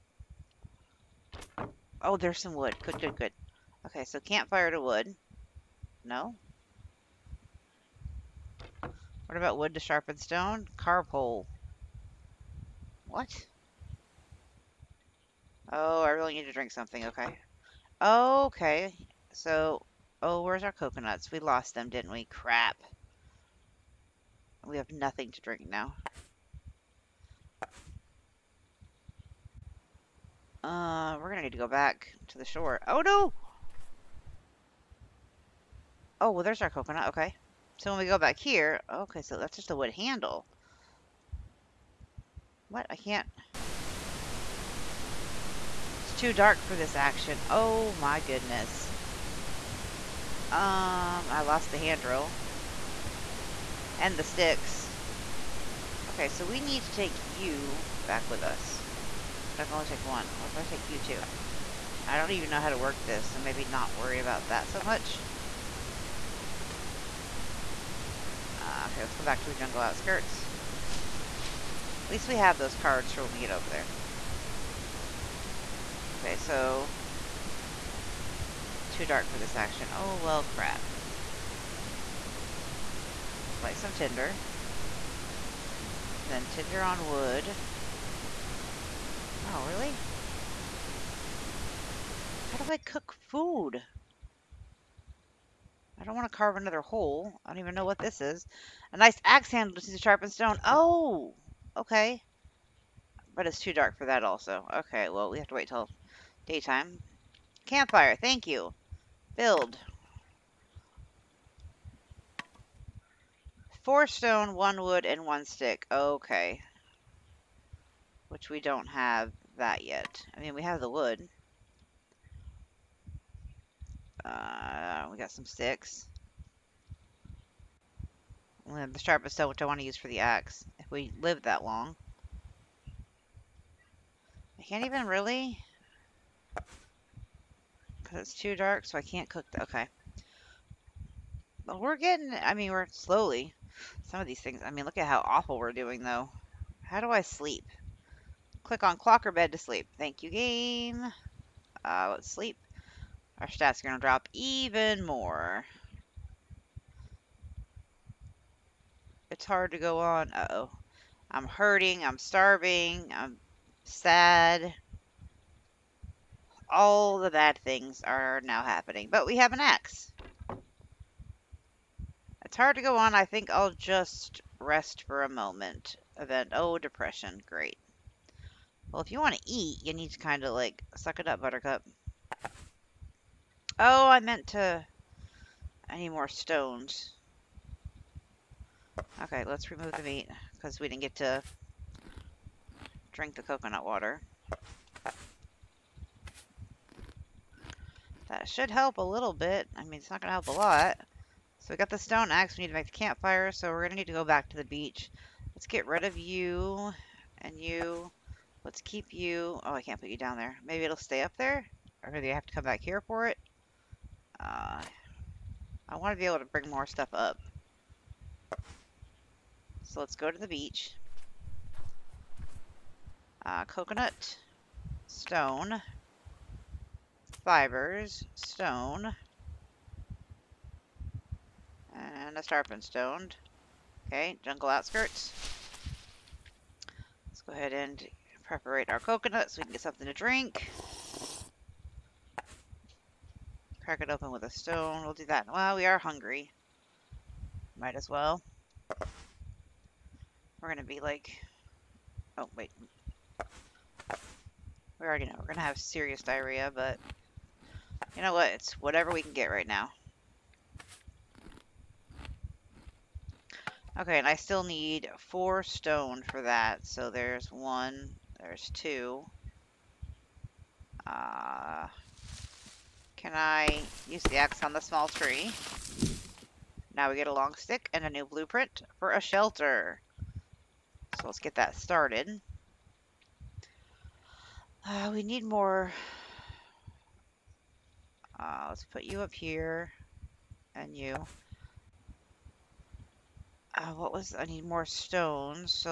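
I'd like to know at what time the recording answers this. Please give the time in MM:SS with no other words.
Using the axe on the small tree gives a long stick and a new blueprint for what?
04:39.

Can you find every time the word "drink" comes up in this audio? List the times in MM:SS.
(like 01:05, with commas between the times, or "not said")
00:16, 00:25, 03:13, 04:00.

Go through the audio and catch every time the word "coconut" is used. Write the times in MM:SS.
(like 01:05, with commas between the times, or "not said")
00:20, 00:36, 03:13, 03:43, 03:59.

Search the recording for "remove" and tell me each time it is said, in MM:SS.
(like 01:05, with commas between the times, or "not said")
03:09.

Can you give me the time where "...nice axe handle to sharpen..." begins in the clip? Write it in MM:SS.
01:38.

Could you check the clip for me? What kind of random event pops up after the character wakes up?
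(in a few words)
depression.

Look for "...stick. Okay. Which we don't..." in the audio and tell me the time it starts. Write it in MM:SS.
01:55.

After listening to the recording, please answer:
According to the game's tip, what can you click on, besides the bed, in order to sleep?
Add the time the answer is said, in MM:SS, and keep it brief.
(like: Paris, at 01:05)
clock, at 02:28.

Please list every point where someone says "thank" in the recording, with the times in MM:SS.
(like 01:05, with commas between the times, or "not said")
01:48, 02:29.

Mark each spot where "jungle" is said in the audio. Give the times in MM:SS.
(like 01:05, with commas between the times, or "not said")
01:09, 03:54.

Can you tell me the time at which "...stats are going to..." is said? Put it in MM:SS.
02:33.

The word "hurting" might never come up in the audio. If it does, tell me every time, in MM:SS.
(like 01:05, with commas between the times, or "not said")
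02:41.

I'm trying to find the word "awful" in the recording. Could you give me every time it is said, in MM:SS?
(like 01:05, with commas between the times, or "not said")
02:25.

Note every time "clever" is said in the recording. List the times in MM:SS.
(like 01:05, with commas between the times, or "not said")
not said.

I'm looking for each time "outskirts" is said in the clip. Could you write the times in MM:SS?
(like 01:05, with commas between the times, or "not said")
01:09, 03:54.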